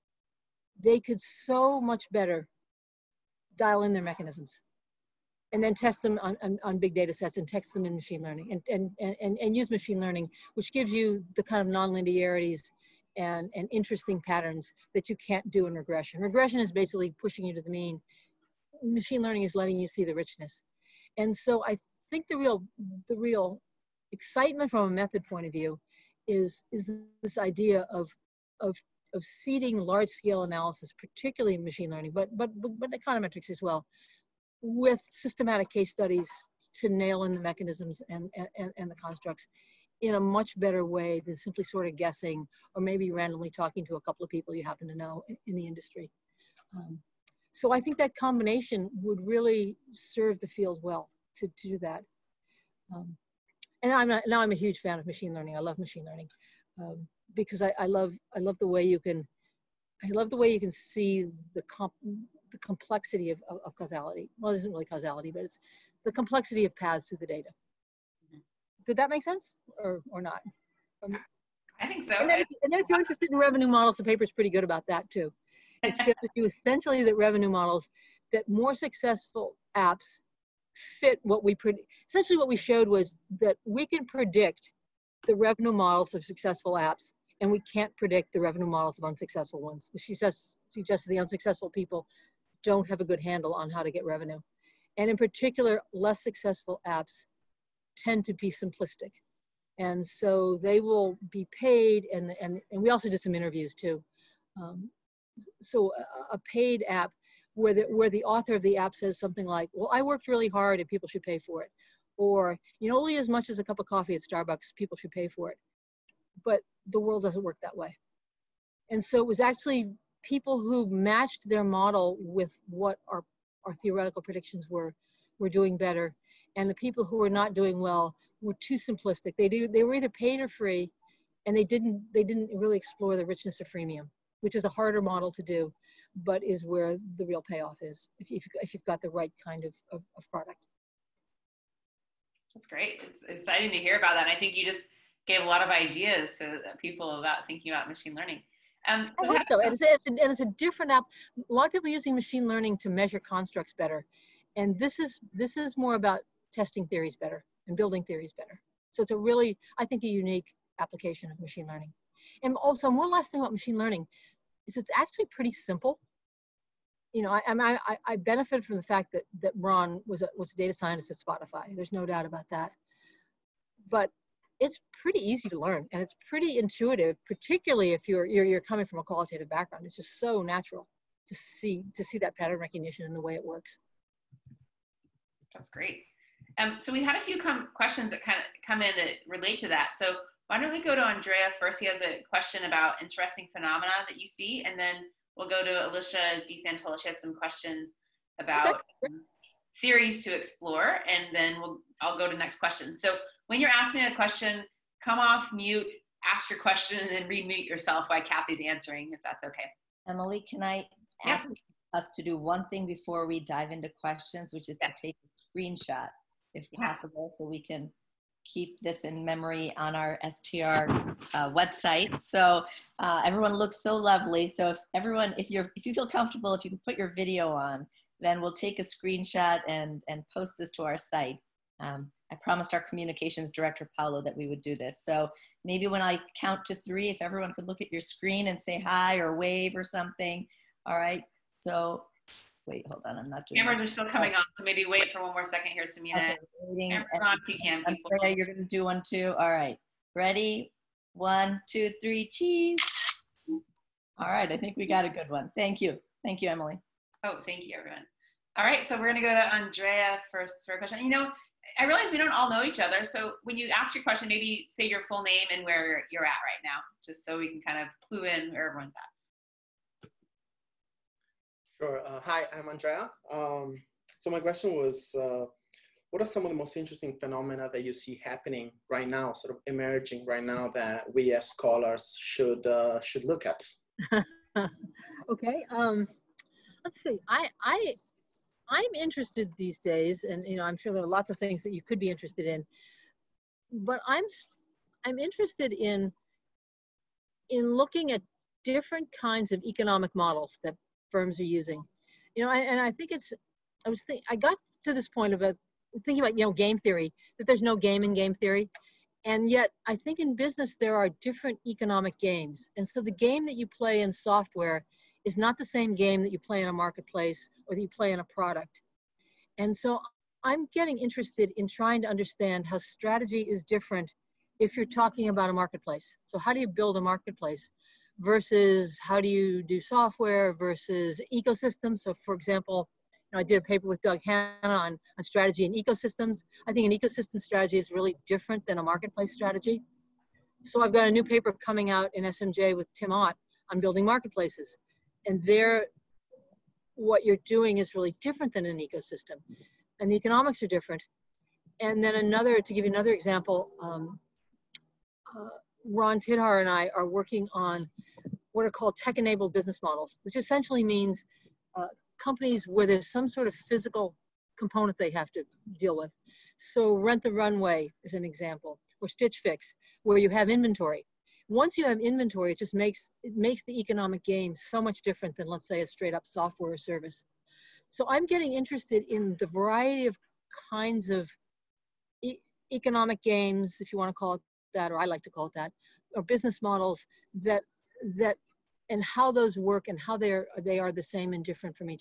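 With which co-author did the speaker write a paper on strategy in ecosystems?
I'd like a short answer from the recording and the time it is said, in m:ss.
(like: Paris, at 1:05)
Doug Hannah, at 5:34.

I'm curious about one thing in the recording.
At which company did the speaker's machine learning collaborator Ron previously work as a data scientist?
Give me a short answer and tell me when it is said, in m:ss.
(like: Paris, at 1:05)
Spotify, at 2:51.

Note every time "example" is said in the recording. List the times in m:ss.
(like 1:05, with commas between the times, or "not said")
5:32, 5:53, 6:08.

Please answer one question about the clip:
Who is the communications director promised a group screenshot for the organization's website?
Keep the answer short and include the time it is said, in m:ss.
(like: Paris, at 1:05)
Paolo, at 3:53.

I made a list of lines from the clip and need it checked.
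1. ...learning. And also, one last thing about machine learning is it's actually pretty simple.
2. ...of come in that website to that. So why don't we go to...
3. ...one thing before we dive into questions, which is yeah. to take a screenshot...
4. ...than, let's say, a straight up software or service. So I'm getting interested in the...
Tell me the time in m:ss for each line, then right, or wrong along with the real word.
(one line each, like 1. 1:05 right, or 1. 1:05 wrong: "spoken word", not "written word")
1. 2:41 right
2. 3:08 wrong: "relate", not "website"
3. 3:32 right
4. 6:15 right.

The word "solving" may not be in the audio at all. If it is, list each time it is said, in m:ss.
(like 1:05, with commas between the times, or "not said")
not said.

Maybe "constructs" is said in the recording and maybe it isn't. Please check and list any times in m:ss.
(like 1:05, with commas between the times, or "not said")
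0:38, 2:33.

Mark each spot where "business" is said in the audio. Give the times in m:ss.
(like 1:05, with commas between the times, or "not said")
5:10, 5:59, 6:26.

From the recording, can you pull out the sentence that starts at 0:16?
Regression is basically pushing you to the mean.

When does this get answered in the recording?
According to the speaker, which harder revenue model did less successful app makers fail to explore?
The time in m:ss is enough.
2:13.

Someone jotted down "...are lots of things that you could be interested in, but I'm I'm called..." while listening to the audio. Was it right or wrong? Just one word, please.
wrong.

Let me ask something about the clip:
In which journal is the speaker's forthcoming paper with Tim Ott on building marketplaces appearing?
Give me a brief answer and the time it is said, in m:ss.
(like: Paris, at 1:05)
SMJ, at 5:42.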